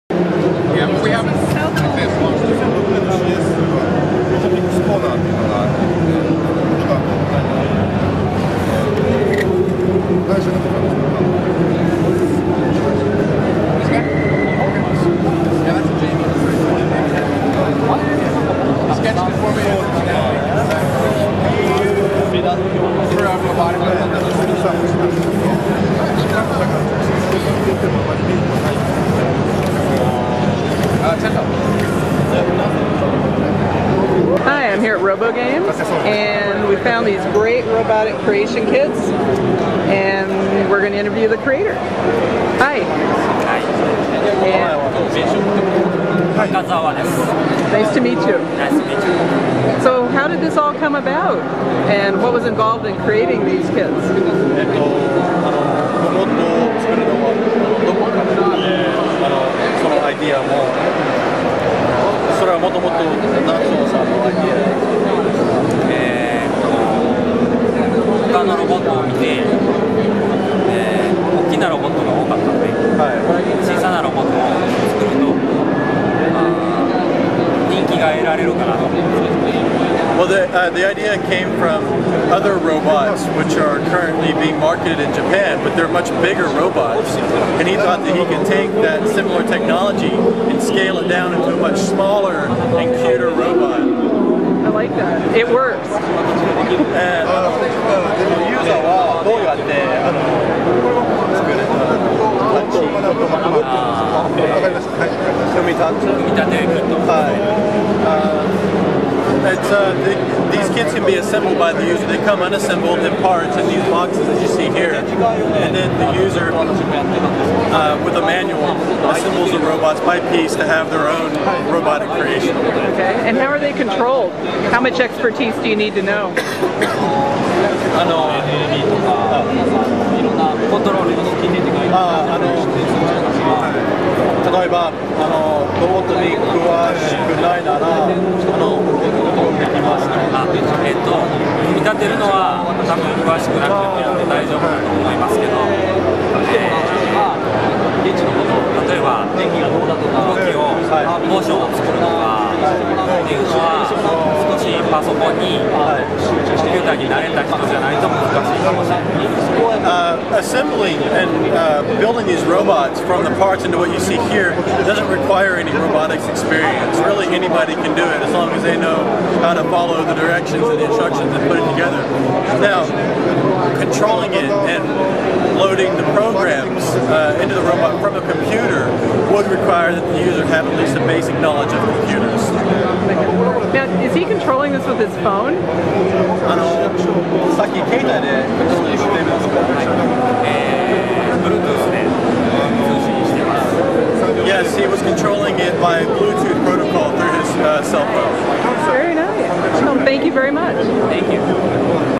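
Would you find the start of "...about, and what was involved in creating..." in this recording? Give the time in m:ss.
0:50.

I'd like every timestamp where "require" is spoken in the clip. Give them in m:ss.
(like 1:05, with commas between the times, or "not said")
2:45, 2:59.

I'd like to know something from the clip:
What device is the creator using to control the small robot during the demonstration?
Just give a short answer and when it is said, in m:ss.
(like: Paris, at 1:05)
cell phone, at 3:17.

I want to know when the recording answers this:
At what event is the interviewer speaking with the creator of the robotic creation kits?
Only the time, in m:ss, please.
0:35.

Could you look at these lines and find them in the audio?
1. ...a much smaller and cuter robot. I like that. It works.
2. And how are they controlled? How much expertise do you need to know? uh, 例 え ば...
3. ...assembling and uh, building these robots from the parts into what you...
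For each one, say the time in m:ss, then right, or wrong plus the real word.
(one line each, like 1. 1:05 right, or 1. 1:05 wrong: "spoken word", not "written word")
1. 1:31 right
2. 2:03 right
3. 2:40 right.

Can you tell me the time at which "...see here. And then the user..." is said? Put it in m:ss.
1:54.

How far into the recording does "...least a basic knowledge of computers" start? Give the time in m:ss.
3:00.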